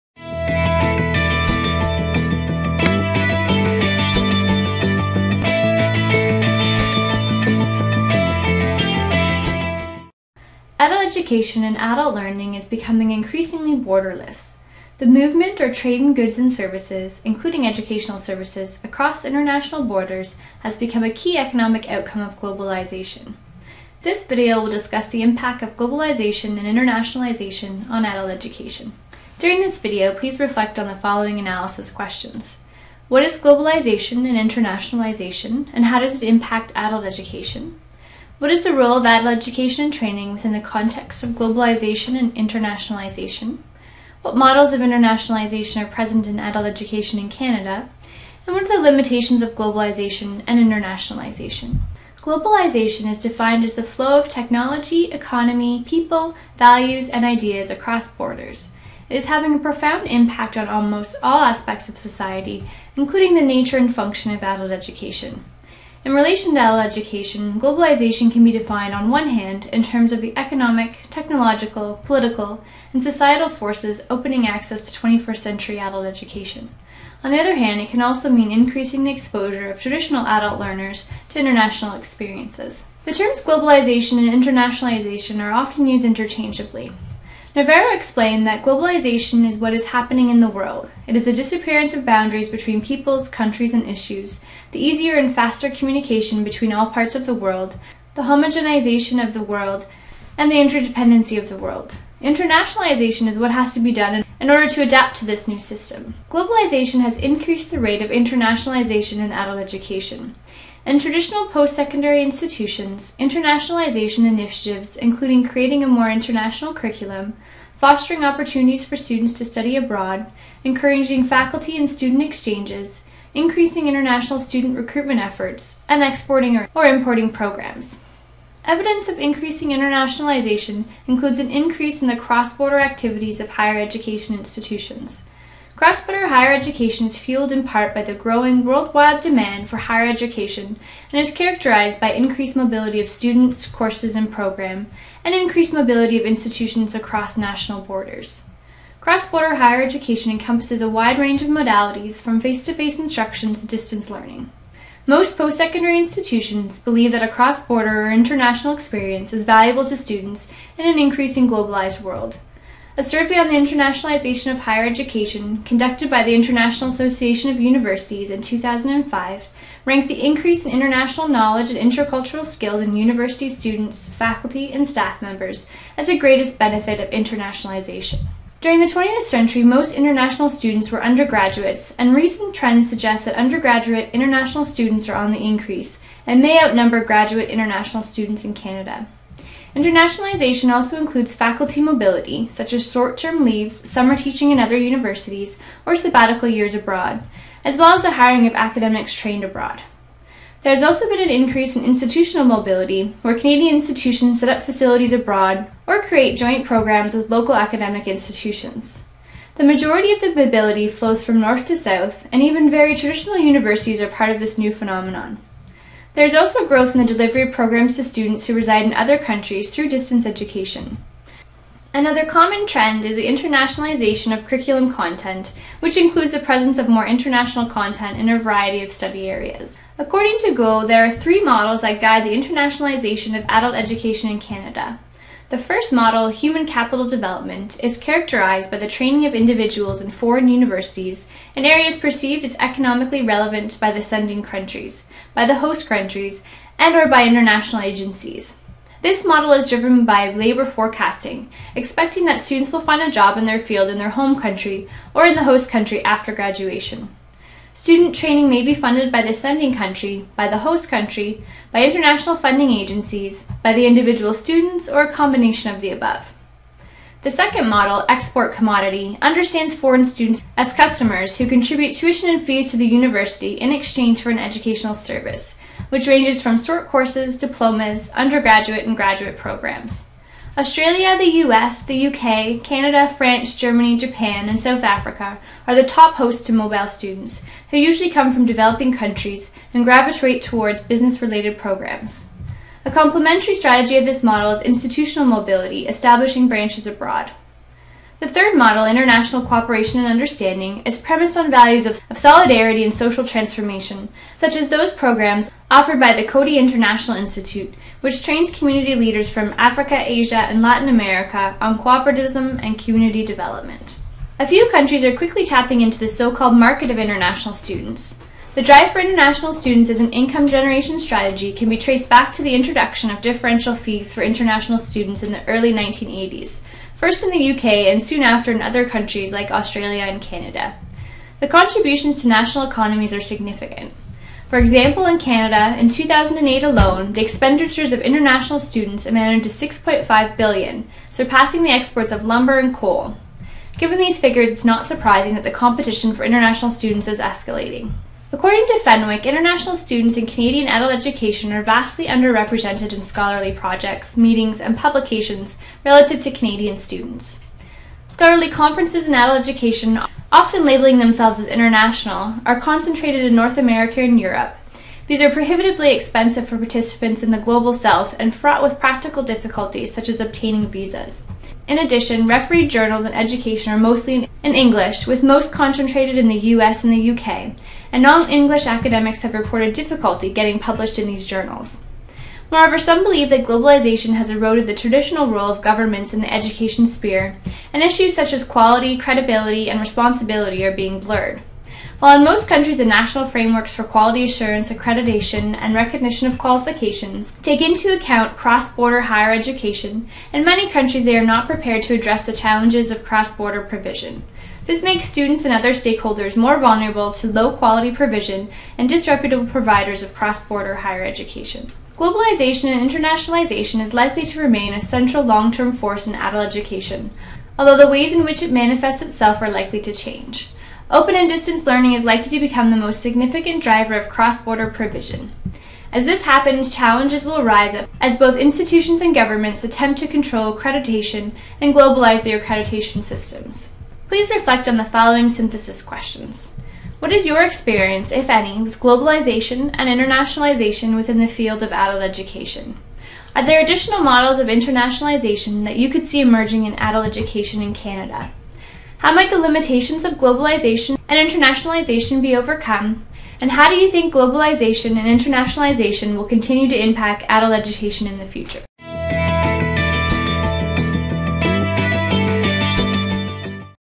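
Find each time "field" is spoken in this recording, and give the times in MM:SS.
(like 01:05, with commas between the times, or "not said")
04:13, 07:21.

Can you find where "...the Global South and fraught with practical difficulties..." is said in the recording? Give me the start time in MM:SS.
06:07.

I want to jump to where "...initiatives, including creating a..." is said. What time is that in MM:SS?
01:54.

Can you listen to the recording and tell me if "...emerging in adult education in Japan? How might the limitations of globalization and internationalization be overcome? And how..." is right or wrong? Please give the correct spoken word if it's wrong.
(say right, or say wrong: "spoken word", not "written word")
wrong: "Canada", not "Japan".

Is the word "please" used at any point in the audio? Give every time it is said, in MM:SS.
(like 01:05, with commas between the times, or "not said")
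00:30, 07:14.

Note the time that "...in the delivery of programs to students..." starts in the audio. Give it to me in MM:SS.
03:36.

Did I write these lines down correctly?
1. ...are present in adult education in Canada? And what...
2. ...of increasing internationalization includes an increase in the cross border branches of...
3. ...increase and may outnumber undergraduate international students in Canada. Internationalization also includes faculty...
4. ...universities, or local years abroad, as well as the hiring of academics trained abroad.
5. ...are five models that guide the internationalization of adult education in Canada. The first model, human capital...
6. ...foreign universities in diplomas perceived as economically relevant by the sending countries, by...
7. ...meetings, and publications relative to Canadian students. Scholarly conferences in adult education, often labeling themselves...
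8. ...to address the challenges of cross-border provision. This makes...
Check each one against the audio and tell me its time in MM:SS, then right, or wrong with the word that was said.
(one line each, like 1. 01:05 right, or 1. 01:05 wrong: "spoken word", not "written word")
1. 00:45 right
2. 02:09 wrong: "activities", not "branches"
3. 03:05 wrong: "graduate", not "undergraduate"
4. 03:14 wrong: "sabbatical", not "local"
5. 03:51 wrong: "three", not "five"
6. 04:00 wrong: "areas", not "diplomas"
7. 05:54 right
8. 06:41 right.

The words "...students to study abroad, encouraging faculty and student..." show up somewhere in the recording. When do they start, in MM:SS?
01:58.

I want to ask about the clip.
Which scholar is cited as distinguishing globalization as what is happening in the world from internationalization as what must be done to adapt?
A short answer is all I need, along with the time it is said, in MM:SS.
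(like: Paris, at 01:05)
Navarro, at 01:27.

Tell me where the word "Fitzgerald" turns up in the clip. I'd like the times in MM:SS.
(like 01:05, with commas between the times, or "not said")
not said.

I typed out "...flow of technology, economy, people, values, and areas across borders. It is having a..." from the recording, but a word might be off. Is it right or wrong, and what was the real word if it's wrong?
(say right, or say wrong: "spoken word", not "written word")
wrong: "ideas", not "areas".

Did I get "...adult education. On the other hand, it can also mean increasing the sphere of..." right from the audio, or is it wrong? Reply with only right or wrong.
wrong.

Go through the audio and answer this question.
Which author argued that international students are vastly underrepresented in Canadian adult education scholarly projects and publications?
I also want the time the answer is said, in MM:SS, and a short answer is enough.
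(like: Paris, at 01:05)
Fenwick, at 05:48.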